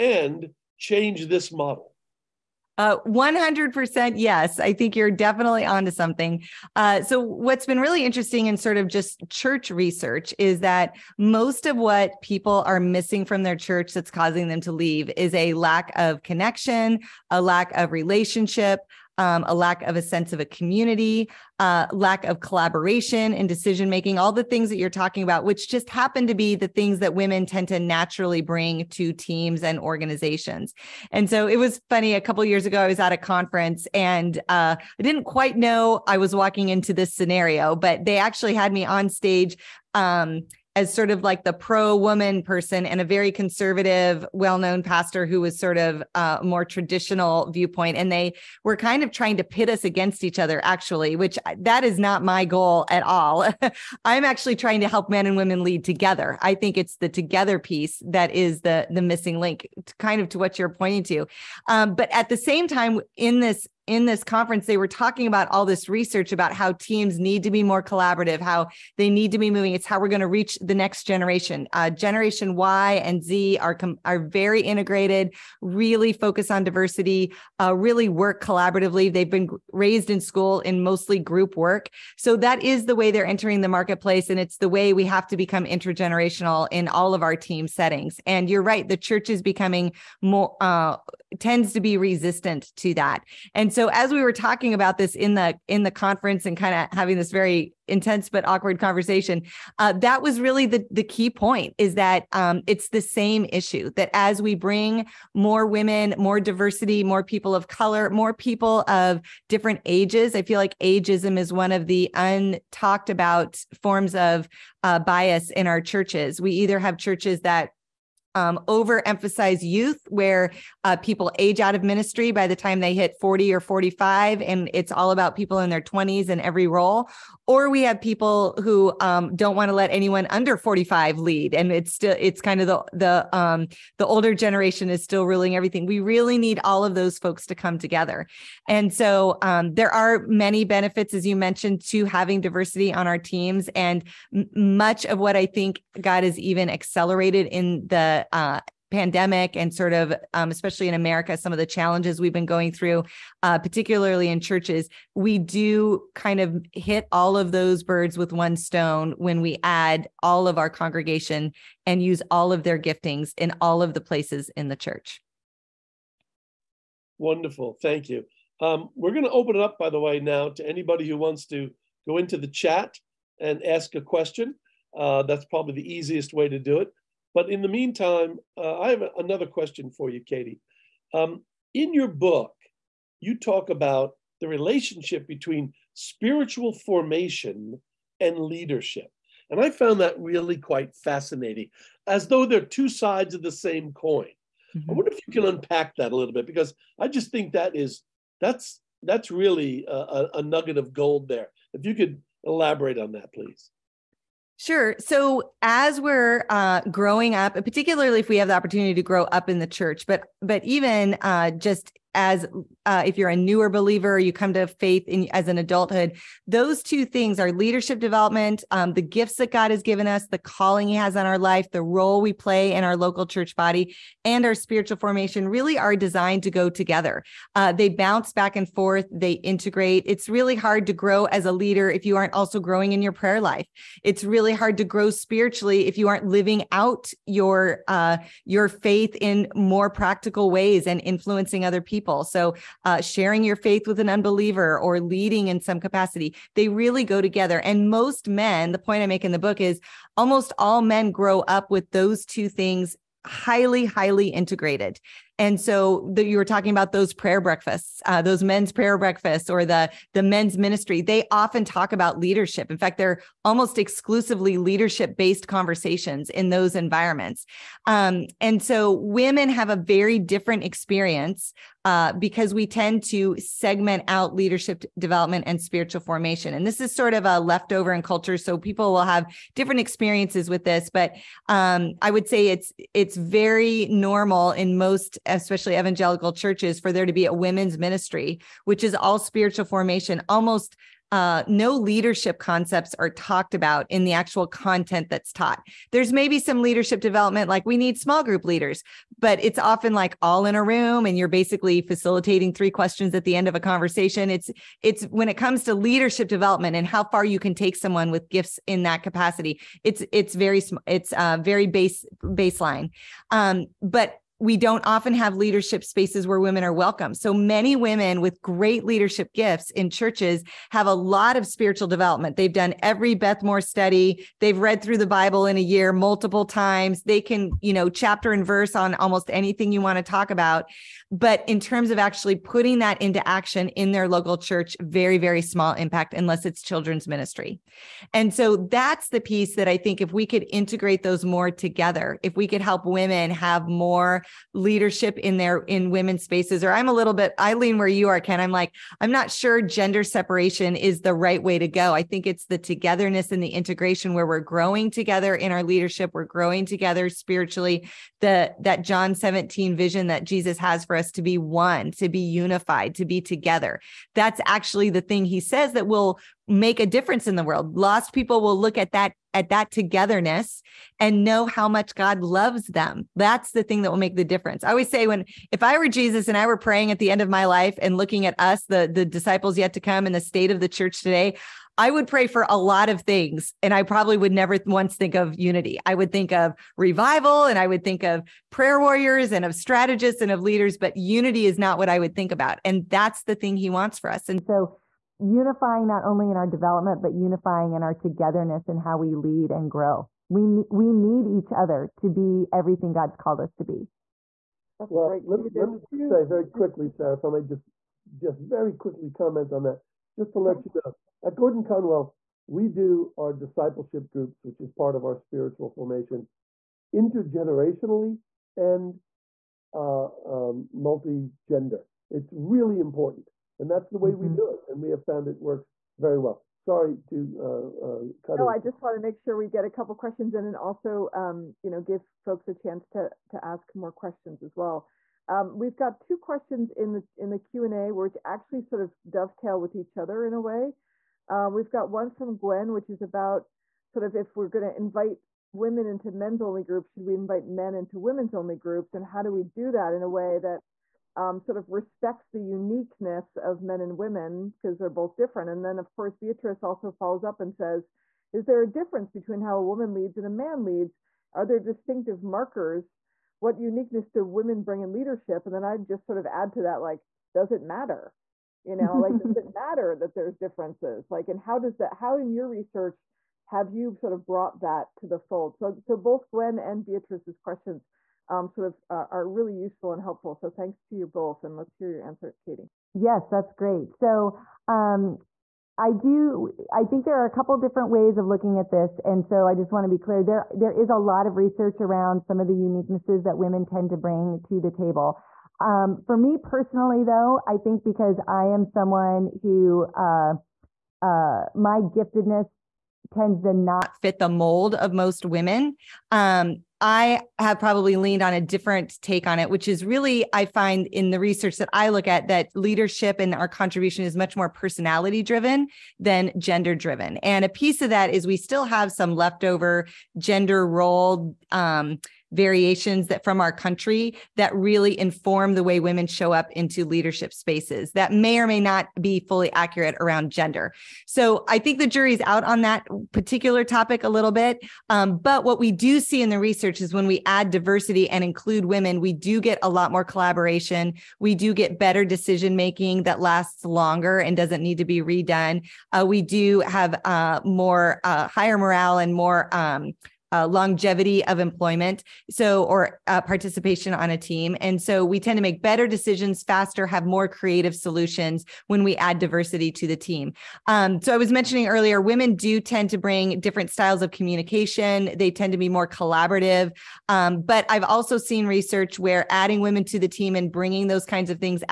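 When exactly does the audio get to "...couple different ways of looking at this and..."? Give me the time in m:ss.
8:07.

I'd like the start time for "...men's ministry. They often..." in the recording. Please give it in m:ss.
4:20.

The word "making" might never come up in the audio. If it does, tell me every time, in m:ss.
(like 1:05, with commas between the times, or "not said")
0:23, 9:02.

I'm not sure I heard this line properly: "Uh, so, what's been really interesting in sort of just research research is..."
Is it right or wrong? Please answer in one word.
wrong.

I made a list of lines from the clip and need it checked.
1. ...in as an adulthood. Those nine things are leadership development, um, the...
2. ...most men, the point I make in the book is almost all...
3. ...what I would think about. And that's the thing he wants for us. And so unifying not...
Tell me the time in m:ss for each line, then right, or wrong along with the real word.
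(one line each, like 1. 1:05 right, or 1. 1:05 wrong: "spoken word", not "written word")
1. 3:35 wrong: "two", not "nine"
2. 4:07 right
3. 6:31 right.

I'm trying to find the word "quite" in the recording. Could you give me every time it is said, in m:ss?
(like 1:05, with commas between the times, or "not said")
0:35, 3:10.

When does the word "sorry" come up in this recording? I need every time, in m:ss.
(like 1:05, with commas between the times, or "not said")
7:06.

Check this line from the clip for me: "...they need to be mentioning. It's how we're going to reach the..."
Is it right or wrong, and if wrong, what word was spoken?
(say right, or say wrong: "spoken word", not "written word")
wrong: "moving", not "mentioning".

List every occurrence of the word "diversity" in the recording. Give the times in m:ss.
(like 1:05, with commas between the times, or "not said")
1:16, 1:46, 2:22, 8:57, 9:19.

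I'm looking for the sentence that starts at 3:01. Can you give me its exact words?
Um, in your book, you talk about the relationship between spiritual formation and leadership.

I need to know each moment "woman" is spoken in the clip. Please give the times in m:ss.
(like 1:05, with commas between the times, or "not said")
0:41, 7:39.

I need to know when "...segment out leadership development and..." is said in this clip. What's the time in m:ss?
4:33.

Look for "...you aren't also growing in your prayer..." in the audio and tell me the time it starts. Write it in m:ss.
3:52.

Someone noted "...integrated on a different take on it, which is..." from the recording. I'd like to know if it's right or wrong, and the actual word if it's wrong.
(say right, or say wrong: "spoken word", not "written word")
wrong: "leaned", not "integrated".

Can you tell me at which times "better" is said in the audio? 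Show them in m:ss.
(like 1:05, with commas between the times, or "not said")
9:01, 9:15.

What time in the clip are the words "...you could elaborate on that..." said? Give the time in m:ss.
3:21.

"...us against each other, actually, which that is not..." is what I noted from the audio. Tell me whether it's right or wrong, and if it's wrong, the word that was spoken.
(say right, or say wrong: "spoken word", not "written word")
right.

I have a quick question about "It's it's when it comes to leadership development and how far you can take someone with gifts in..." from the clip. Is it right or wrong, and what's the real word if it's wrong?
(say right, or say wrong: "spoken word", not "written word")
right.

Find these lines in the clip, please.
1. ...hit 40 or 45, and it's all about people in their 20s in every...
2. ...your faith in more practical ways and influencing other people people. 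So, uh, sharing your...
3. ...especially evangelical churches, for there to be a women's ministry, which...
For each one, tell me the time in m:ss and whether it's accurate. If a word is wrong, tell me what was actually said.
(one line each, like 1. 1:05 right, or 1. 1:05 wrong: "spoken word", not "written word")
1. 2:02 right
2. 3:58 right
3. 4:45 right.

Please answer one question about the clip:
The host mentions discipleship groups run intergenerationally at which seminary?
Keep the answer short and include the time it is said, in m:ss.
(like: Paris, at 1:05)
Gordon Conwell, at 6:51.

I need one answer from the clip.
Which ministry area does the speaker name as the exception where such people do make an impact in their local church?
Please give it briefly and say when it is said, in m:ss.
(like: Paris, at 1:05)
Children's ministry, at 5:36.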